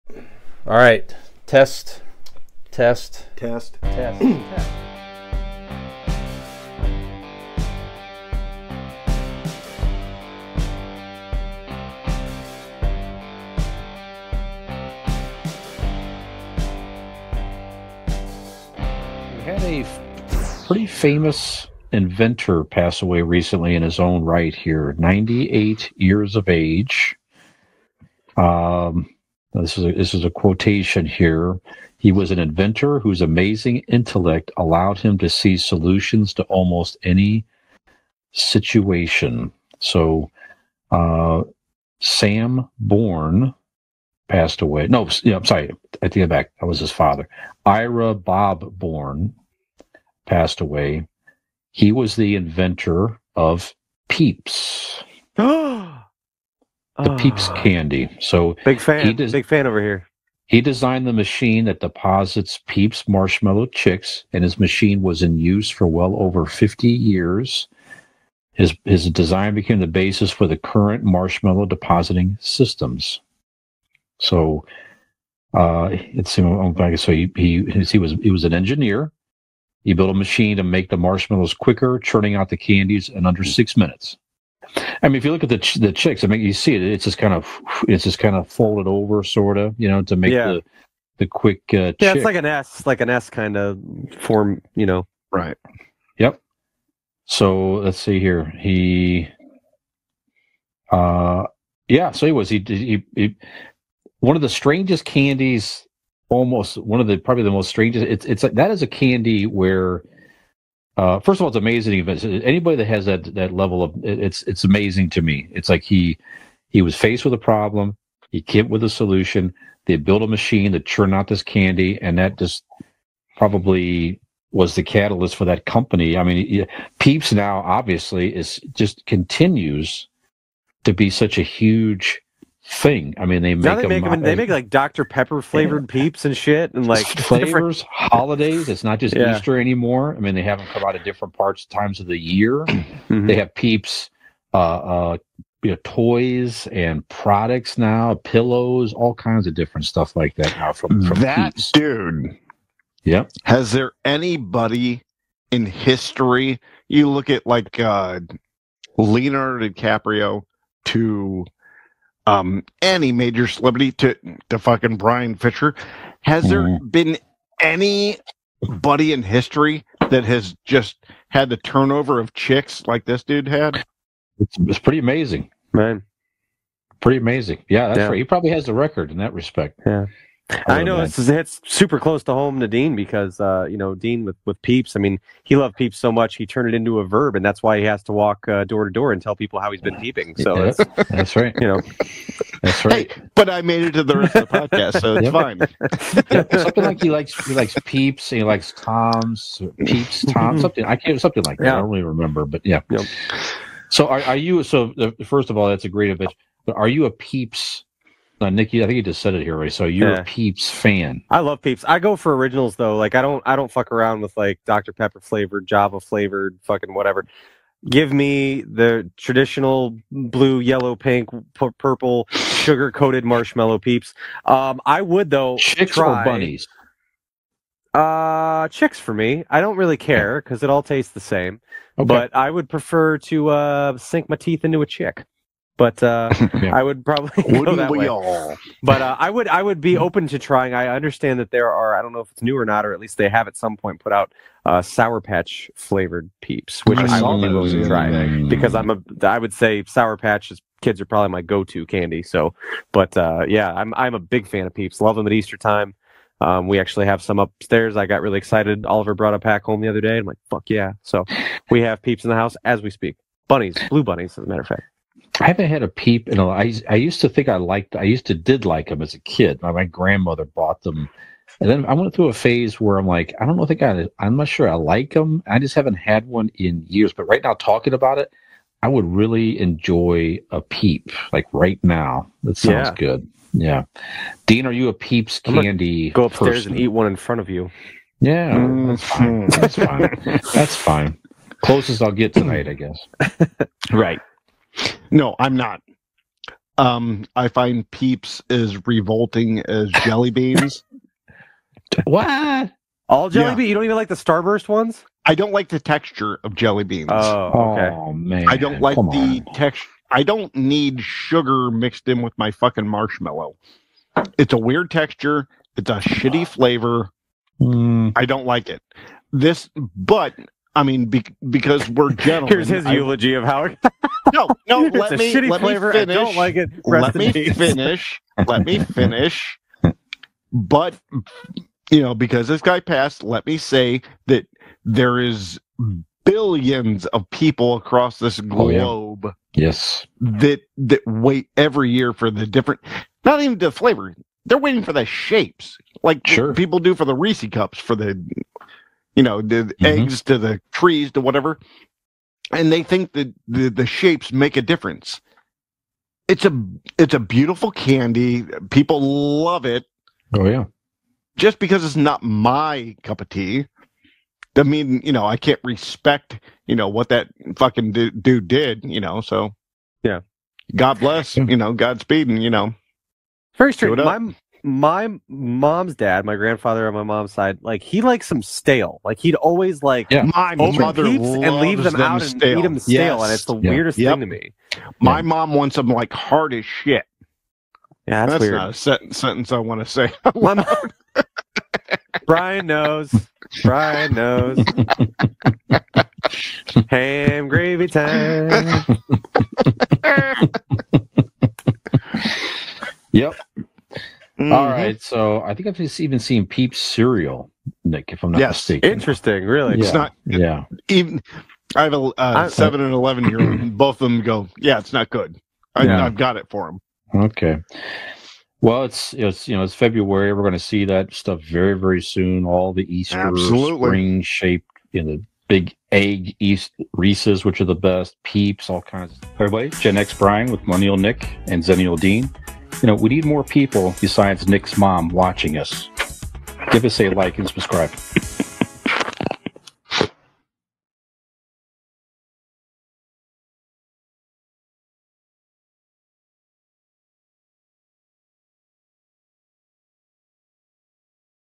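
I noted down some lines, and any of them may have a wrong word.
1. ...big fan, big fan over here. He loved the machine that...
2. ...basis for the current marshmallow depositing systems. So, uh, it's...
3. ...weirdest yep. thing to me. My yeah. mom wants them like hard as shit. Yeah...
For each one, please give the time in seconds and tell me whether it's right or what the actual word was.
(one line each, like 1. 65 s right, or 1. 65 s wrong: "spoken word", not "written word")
1. 58 s wrong: "designed", not "loved"
2. 69 s right
3. 383 s right.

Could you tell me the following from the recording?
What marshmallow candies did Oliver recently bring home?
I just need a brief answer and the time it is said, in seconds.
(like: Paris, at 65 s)
blue bunnies, at 263 s.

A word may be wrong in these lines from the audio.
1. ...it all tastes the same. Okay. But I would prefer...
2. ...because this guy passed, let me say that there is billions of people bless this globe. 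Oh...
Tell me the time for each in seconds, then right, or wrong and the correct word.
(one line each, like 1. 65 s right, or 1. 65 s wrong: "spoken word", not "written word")
1. 230 s right
2. 332 s wrong: "across", not "bless".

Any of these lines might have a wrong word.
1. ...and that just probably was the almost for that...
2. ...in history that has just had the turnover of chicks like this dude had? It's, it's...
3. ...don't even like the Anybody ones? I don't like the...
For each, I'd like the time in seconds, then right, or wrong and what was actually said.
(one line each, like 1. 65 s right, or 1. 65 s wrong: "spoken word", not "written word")
1. 122 s wrong: "catalyst", not "almost"
2. 169 s right
3. 303 s wrong: "Starburst", not "Anybody".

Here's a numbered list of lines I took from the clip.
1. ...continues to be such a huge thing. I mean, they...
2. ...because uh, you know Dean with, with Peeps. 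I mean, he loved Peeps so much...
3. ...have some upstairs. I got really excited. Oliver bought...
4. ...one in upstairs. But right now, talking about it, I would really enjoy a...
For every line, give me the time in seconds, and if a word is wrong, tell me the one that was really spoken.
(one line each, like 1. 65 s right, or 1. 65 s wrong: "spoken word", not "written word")
1. 129 s right
2. 182 s right
3. 257 s wrong: "brought", not "bought"
4. 276 s wrong: "years", not "upstairs".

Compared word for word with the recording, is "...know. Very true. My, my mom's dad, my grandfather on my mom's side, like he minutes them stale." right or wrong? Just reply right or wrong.
wrong.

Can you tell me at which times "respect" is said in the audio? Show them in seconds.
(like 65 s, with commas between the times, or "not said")
179 s, 365 s.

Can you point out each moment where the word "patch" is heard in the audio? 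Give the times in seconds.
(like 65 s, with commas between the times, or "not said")
245 s, 250 s.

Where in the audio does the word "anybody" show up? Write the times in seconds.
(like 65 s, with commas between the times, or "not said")
112 s, 154 s.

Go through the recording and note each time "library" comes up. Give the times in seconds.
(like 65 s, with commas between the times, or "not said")
not said.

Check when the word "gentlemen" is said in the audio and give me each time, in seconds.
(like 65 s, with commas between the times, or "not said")
322 s.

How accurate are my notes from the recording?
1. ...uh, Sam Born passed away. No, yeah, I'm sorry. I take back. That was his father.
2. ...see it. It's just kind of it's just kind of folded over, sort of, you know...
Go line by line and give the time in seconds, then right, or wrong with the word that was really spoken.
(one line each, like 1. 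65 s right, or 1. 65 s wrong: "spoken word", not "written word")
1. 40 s right
2. 86 s right.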